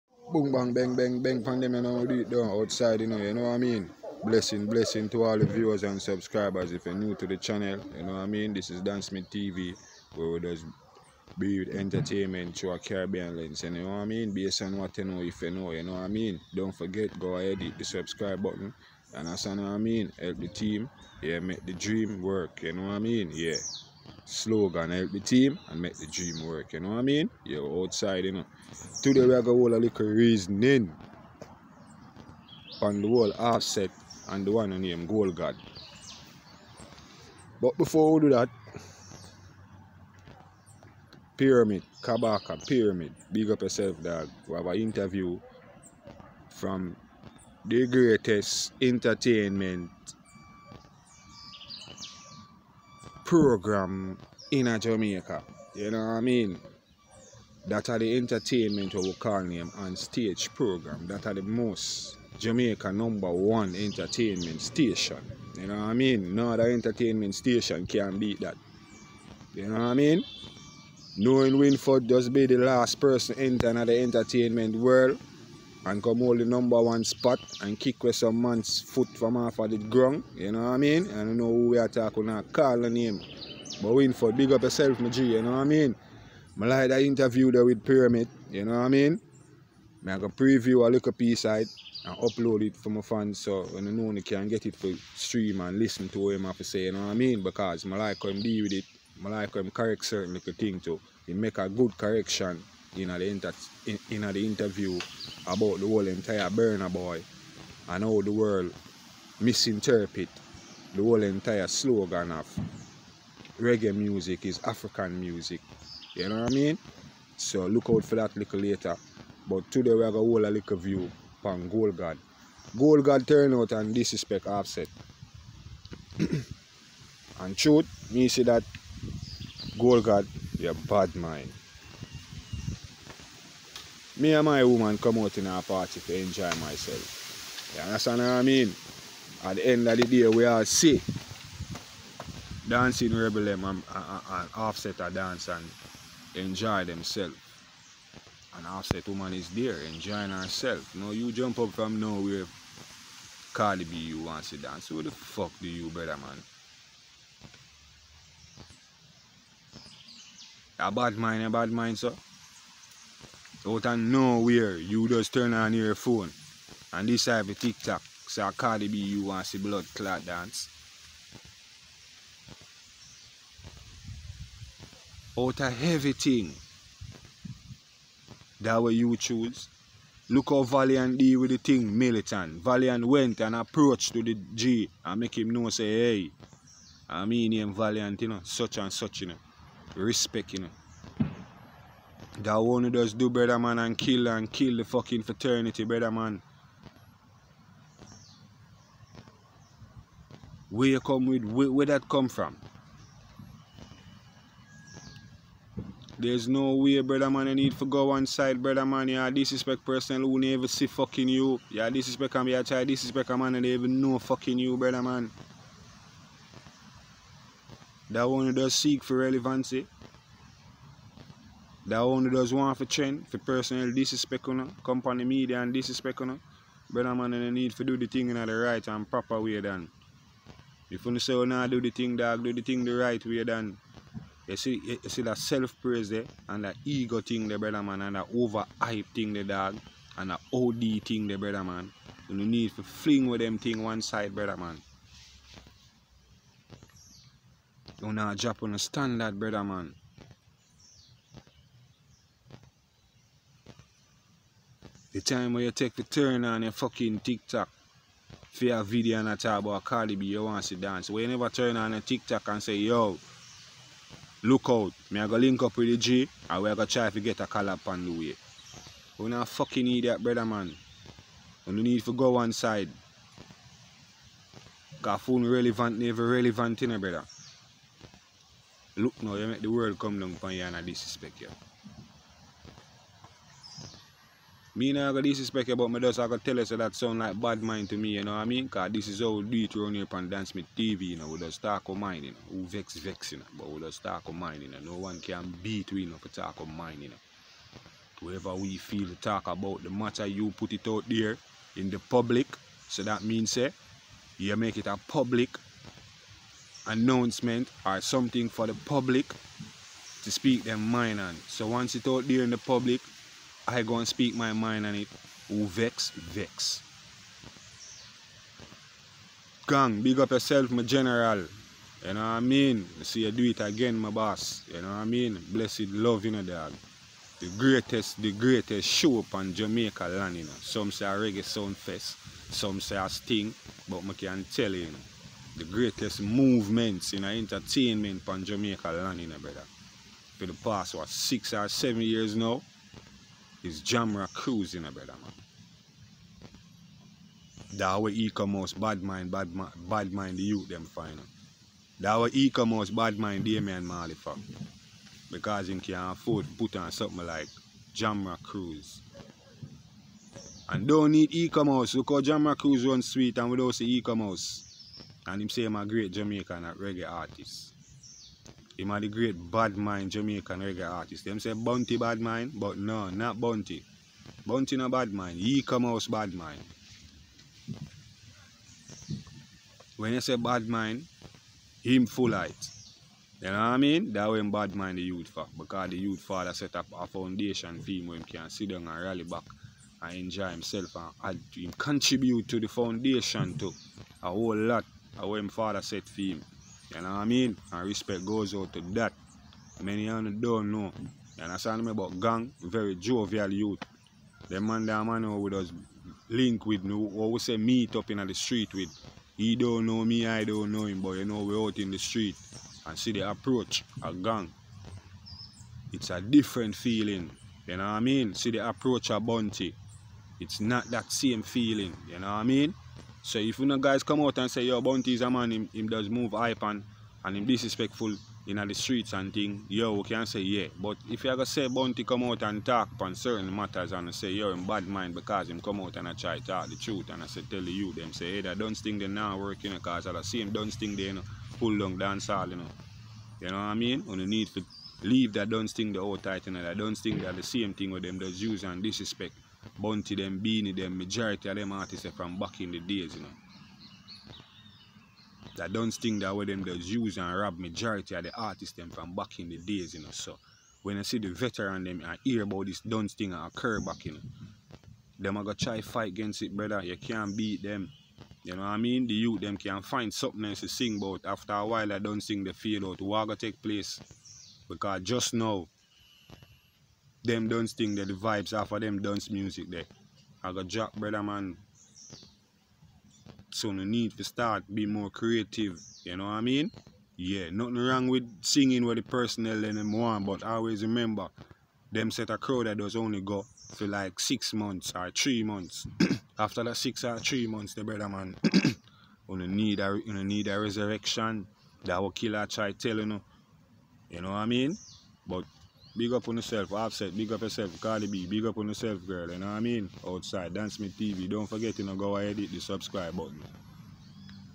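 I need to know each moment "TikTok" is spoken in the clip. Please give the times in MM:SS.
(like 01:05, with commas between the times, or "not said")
02:47, 04:17, 04:21.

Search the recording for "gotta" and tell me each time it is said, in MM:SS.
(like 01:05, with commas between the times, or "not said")
07:45.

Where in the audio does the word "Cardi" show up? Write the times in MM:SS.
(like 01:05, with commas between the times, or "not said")
02:33, 02:48, 04:19, 08:27.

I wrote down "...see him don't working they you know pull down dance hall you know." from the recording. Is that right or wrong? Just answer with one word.
wrong.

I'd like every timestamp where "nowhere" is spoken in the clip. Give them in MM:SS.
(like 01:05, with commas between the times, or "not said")
02:31, 02:43.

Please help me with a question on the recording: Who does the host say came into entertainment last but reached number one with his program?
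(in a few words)
Winford.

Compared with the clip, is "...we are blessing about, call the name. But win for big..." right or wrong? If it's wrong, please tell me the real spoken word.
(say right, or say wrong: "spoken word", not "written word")
wrong: "talking", not "blessing".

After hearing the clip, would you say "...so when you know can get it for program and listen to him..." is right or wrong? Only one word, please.
wrong.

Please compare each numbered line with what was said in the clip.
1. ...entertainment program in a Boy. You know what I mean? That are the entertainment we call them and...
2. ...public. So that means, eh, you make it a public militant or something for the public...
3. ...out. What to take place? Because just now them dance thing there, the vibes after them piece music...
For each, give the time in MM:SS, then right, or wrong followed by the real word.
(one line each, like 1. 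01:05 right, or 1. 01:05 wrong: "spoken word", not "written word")
1. 00:48 wrong: "Jamaica", not "Boy"
2. 05:01 wrong: "announcement", not "militant"
3. 07:52 wrong: "dance", not "piece".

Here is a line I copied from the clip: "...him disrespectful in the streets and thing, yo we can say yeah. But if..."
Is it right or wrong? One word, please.
right.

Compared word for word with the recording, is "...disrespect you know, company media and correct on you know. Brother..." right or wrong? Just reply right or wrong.
wrong.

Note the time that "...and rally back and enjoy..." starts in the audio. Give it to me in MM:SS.
06:28.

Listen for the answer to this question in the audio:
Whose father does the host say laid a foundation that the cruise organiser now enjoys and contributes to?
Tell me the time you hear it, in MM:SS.
05:53.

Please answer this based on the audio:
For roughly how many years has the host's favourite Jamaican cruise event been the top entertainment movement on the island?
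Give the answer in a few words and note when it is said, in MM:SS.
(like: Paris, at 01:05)
six or seven years, at 05:41.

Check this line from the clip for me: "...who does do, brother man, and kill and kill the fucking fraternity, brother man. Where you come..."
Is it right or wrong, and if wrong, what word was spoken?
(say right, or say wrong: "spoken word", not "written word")
right.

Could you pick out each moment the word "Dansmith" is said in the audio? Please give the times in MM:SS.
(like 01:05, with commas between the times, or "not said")
00:08, 04:50, 08:30.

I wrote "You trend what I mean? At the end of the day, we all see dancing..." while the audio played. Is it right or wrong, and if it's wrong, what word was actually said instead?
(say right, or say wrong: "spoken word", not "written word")
wrong: "understand", not "trend".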